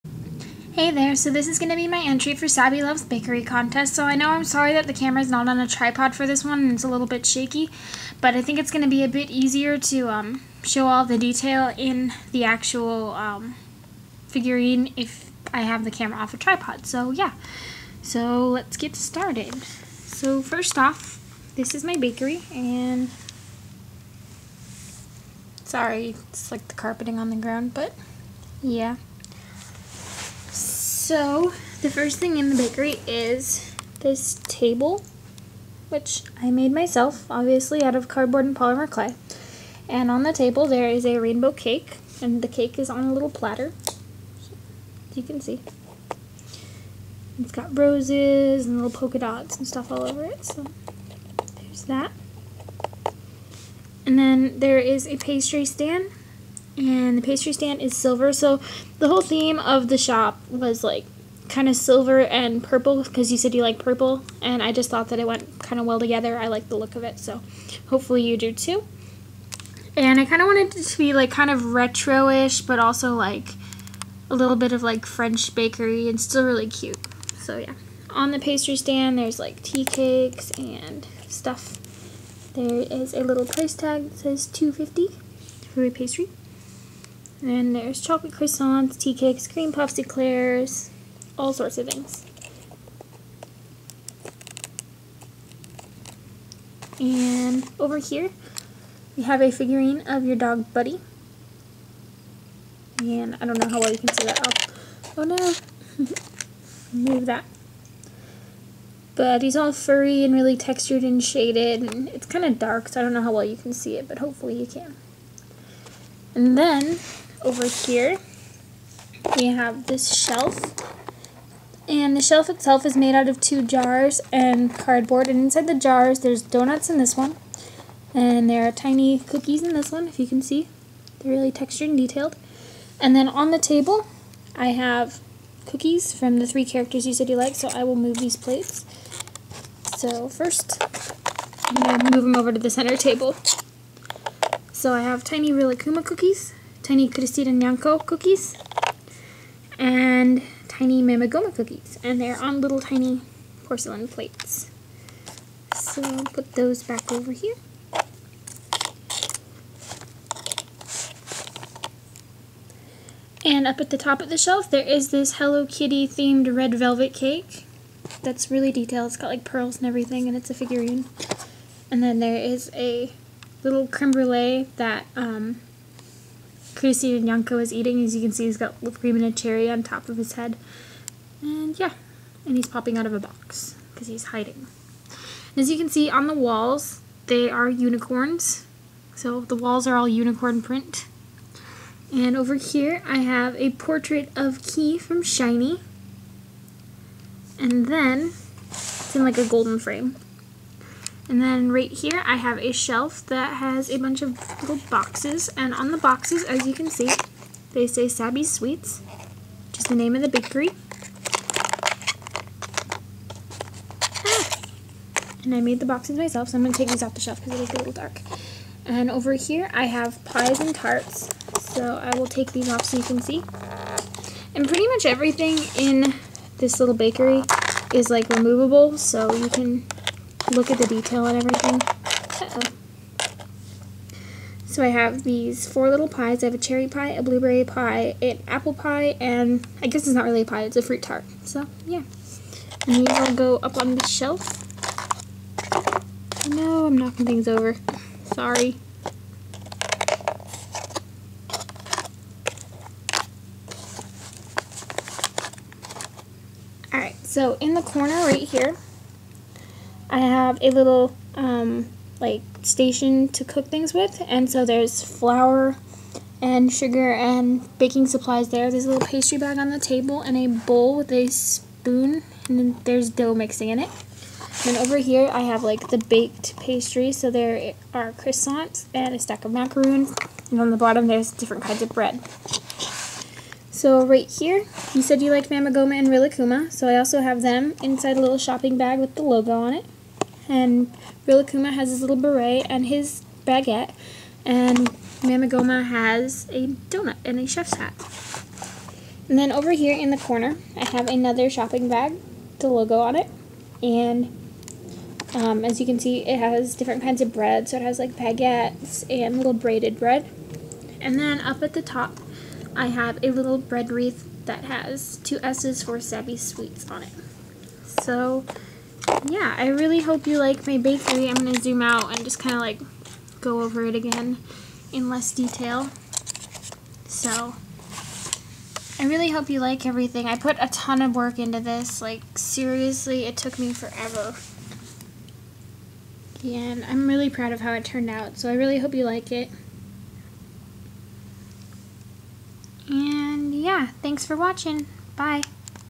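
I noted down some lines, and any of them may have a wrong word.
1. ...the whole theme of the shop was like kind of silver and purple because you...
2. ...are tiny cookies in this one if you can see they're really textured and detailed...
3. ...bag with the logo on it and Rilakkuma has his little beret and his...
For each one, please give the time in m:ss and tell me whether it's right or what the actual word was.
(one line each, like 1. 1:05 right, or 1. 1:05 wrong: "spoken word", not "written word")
1. 0:58 right
2. 2:08 right
3. 4:48 right.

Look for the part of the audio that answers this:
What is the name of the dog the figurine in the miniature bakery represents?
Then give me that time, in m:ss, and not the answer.
1:40.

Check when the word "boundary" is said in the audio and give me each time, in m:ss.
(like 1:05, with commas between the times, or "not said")
not said.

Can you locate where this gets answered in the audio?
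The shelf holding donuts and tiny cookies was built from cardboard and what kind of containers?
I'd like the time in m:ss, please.
2:03.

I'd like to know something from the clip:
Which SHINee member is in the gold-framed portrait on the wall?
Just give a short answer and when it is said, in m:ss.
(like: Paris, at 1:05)
Key, at 3:14.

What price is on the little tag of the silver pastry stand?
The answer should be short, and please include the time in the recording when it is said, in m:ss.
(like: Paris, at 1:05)
250, at 1:24.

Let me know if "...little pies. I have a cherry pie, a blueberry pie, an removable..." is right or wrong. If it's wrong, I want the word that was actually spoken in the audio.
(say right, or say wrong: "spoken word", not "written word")
wrong: "apple", not "removable".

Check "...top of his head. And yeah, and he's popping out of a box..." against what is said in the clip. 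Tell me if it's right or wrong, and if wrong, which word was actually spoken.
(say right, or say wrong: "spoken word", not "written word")
right.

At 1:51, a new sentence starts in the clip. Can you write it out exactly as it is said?
And it's kind of dark, so I don't know how well you can see it, but hopefully you can.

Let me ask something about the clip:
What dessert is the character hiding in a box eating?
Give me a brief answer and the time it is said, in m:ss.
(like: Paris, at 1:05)
creme brulee, at 2:53.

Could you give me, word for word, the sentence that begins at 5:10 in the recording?
And then up at the top, I have a little bread wreath that has two S's for Sabby Sweets on it.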